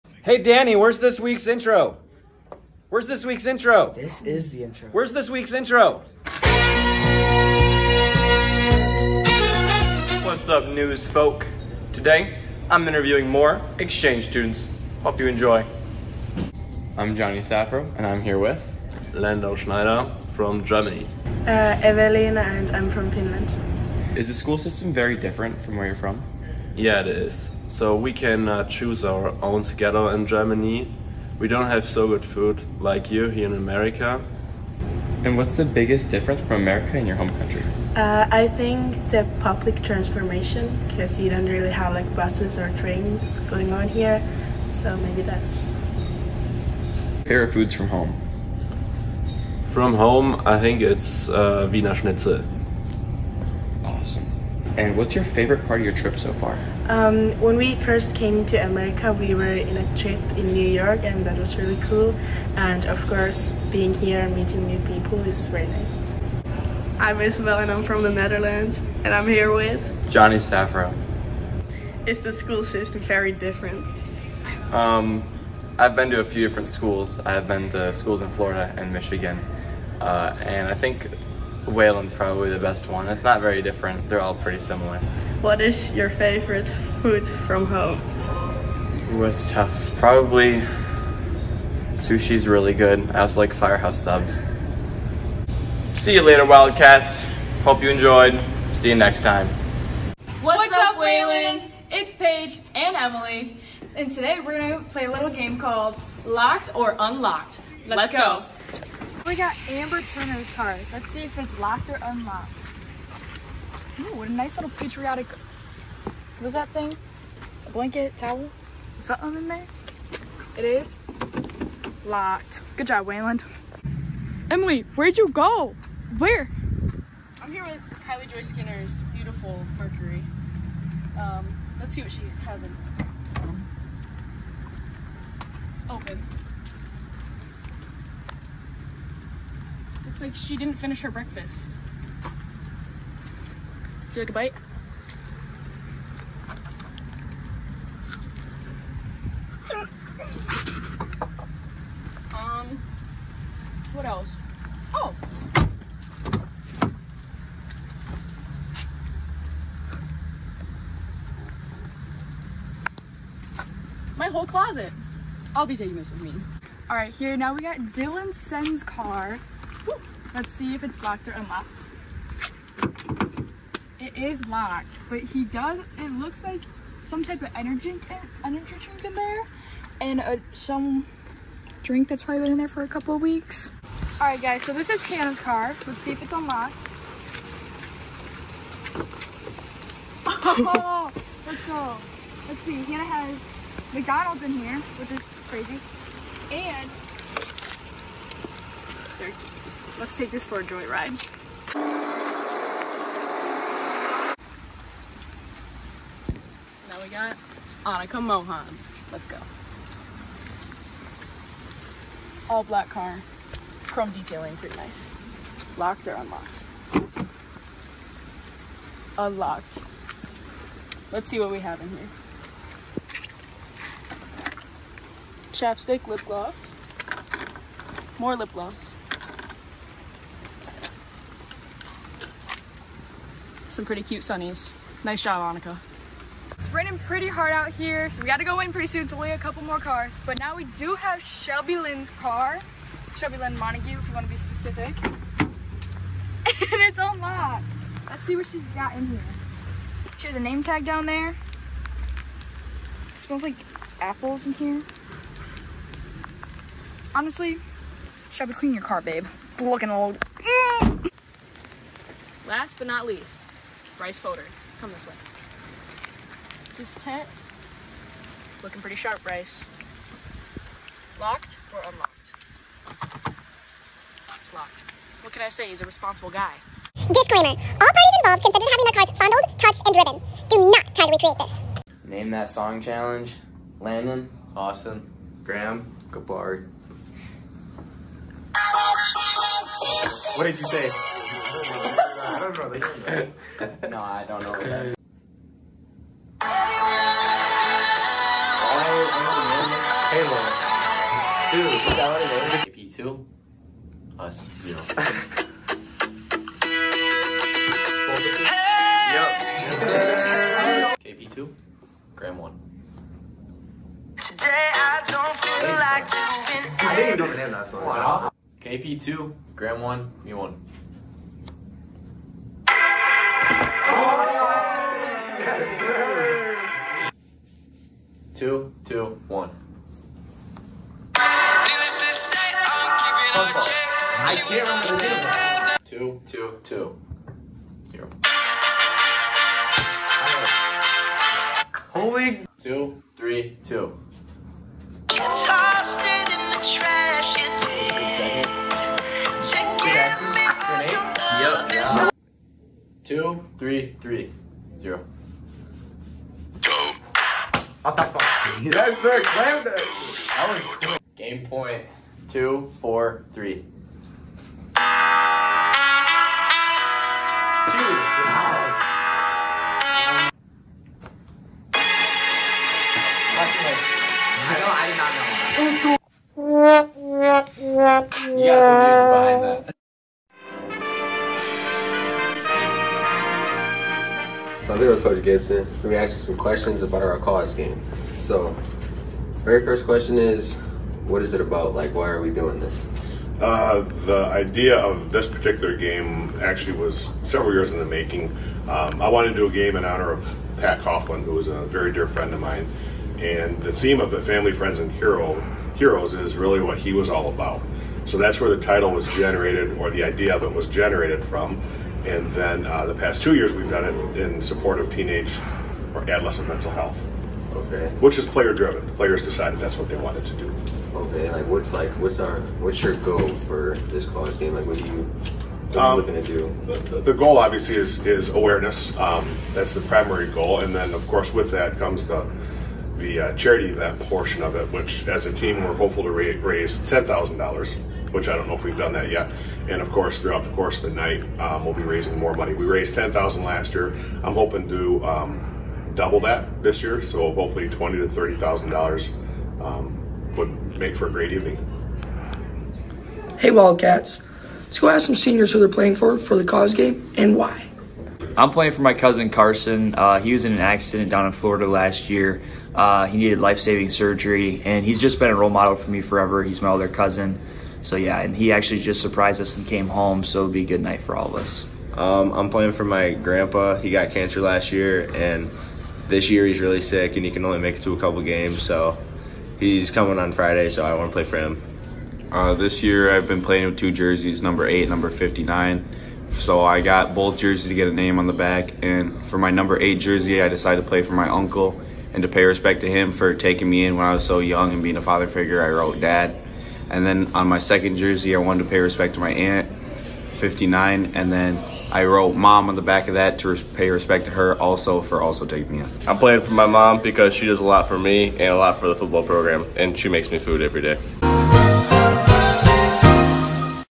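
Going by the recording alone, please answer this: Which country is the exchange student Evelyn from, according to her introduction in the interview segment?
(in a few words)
Finland.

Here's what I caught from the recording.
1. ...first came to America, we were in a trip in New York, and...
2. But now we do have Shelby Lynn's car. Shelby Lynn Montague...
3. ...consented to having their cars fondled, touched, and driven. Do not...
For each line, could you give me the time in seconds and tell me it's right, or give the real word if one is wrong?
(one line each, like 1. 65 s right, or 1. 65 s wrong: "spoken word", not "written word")
1. 57 s right
2. 240 s right
3. 278 s right.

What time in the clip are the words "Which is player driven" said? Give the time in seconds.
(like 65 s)
417 s.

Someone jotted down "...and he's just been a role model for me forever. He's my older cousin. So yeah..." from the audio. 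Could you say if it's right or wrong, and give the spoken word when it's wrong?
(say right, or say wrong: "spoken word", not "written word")
right.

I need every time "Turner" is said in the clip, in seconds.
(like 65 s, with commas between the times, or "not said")
110 s.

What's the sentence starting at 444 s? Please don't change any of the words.
I'm hoping to um, double that this year.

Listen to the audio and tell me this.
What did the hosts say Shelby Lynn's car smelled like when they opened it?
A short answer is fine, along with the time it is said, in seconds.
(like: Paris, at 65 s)
Apples, at 254 s.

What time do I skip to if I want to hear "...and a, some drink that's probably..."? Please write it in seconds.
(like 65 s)
179 s.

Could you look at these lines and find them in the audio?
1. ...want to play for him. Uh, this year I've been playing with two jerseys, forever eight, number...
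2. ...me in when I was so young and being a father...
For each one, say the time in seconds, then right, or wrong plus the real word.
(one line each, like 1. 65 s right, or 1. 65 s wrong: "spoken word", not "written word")
1. 480 s wrong: "number", not "forever"
2. 493 s right.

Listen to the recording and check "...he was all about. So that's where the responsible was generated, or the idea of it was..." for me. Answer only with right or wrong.
wrong.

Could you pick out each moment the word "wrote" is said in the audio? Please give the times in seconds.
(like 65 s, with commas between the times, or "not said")
495 s, 502 s.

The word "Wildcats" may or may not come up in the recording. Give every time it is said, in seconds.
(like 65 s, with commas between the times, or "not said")
96 s, 453 s.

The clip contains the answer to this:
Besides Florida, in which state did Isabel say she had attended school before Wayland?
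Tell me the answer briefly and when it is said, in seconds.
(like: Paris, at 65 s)
Michigan, at 78 s.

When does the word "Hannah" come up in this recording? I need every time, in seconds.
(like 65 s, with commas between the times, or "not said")
185 s, 192 s.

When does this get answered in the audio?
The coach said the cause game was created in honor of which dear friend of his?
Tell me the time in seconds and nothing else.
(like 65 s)
400 s.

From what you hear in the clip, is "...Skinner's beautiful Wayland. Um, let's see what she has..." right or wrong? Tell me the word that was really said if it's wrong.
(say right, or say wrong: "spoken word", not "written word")
wrong: "Mercury", not "Wayland".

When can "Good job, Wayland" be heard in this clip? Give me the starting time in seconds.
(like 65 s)
122 s.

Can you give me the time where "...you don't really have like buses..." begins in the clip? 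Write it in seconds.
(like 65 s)
41 s.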